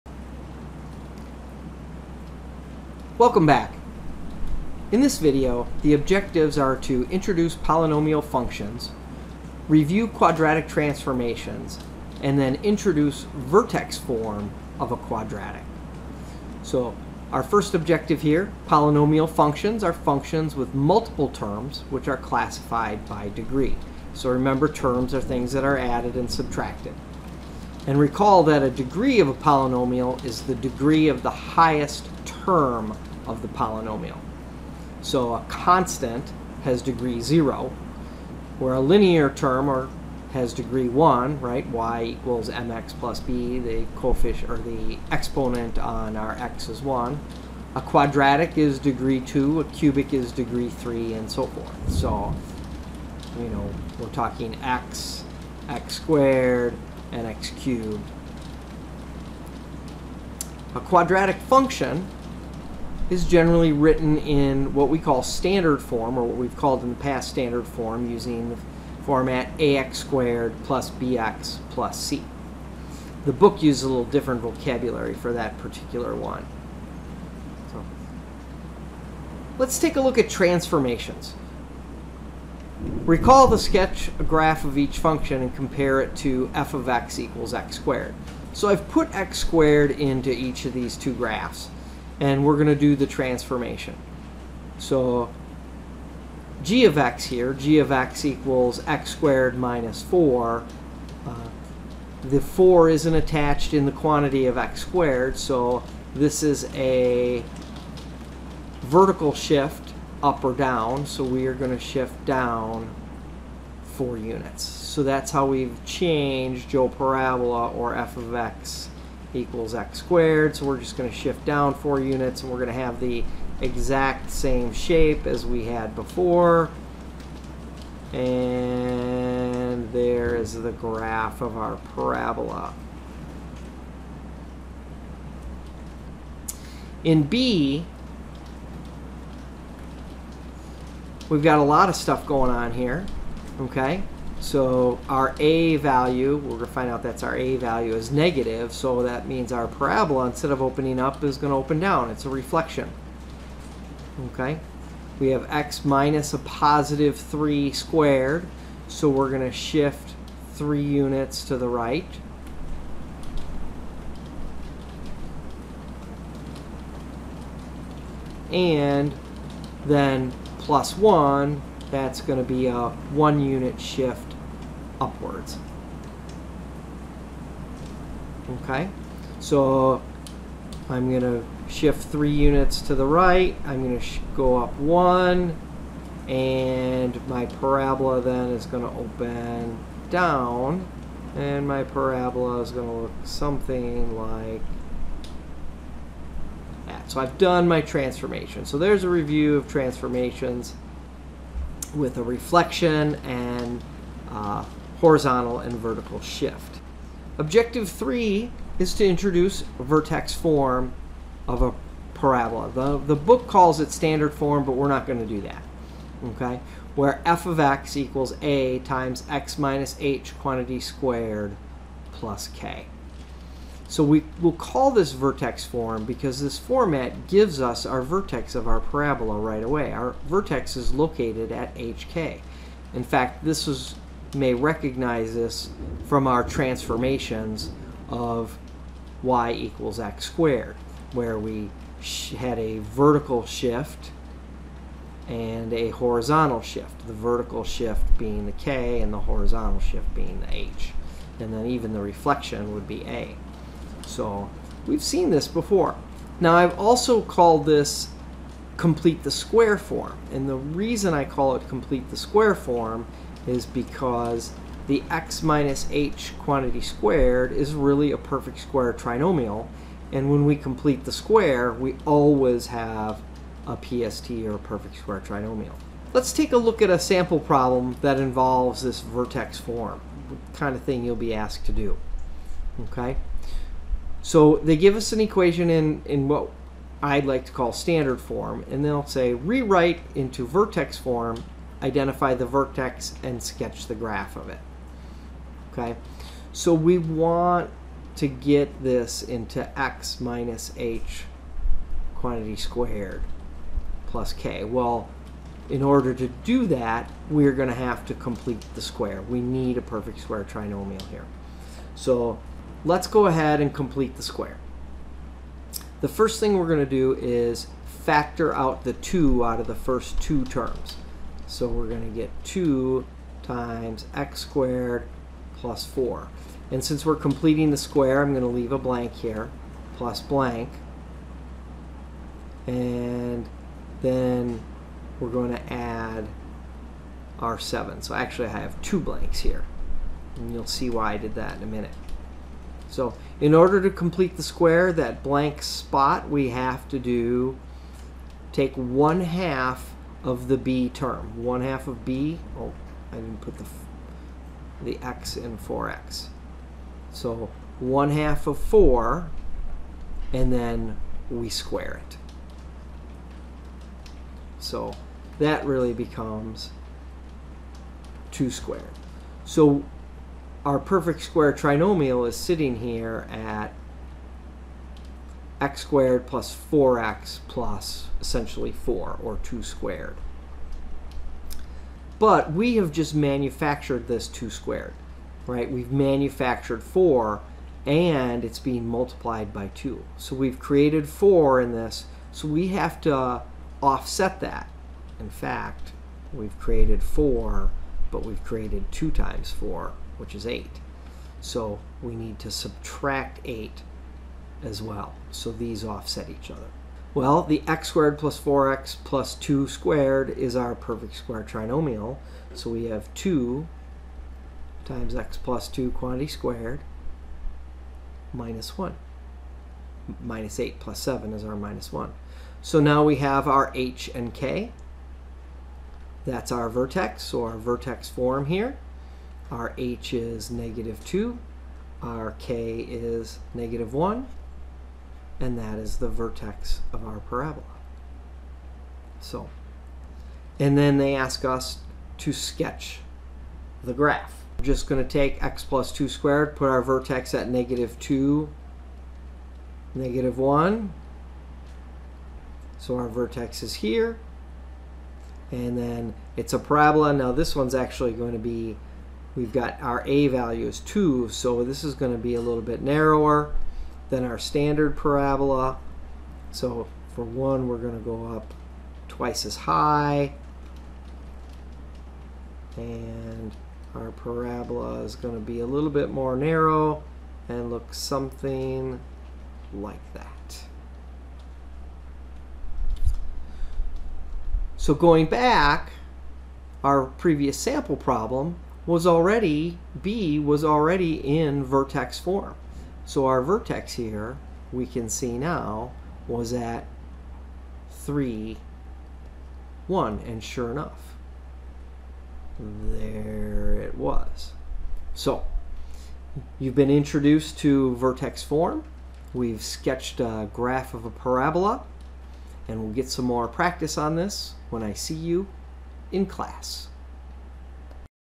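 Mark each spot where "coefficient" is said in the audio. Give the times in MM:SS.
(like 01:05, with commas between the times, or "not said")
00:43.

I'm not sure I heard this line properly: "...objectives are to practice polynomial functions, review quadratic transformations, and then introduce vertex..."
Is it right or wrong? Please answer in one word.
wrong.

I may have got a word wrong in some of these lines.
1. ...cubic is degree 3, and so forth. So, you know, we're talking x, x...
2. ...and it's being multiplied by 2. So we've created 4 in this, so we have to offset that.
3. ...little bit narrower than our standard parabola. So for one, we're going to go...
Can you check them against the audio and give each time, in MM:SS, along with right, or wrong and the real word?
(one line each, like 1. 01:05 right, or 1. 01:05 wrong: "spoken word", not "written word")
1. 00:49 right
2. 06:27 right
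3. 07:42 right.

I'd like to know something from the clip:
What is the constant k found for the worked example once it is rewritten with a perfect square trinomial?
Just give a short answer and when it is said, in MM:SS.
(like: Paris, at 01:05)
-1, at 07:12.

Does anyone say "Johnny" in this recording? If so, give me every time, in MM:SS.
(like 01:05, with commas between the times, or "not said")
not said.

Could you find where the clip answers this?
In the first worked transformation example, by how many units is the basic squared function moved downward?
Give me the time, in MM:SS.
01:51.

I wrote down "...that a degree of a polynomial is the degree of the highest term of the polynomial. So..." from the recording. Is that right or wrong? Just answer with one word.
right.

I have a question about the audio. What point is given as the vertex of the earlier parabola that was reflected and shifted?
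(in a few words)
(3, 1).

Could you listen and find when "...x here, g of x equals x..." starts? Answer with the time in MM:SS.
01:36.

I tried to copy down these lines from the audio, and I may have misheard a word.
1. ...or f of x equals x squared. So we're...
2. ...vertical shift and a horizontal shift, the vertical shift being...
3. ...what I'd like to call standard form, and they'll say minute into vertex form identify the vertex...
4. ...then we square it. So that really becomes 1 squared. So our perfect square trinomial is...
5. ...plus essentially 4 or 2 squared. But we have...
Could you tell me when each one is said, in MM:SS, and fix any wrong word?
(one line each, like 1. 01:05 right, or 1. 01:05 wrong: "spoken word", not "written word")
1. 01:57 right
2. 04:02 right
3. 04:46 wrong: "rewrite", not "minute"
4. 06:00 wrong: "2", not "1"
5. 06:17 right.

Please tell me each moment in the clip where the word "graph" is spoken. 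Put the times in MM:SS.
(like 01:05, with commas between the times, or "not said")
01:24, 01:31, 02:10, 04:53, 07:23, 08:30.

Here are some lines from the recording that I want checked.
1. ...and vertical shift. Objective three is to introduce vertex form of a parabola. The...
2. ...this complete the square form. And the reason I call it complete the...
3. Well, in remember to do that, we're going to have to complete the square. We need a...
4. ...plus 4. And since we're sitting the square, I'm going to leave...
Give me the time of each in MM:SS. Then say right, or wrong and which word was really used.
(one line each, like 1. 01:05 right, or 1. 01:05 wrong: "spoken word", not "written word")
1. 03:25 right
2. 04:17 right
3. 05:04 wrong: "order", not "remember"
4. 05:25 wrong: "completing", not "sitting".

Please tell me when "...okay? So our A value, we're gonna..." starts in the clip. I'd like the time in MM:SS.
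02:23.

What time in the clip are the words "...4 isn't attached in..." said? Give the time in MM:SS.
01:42.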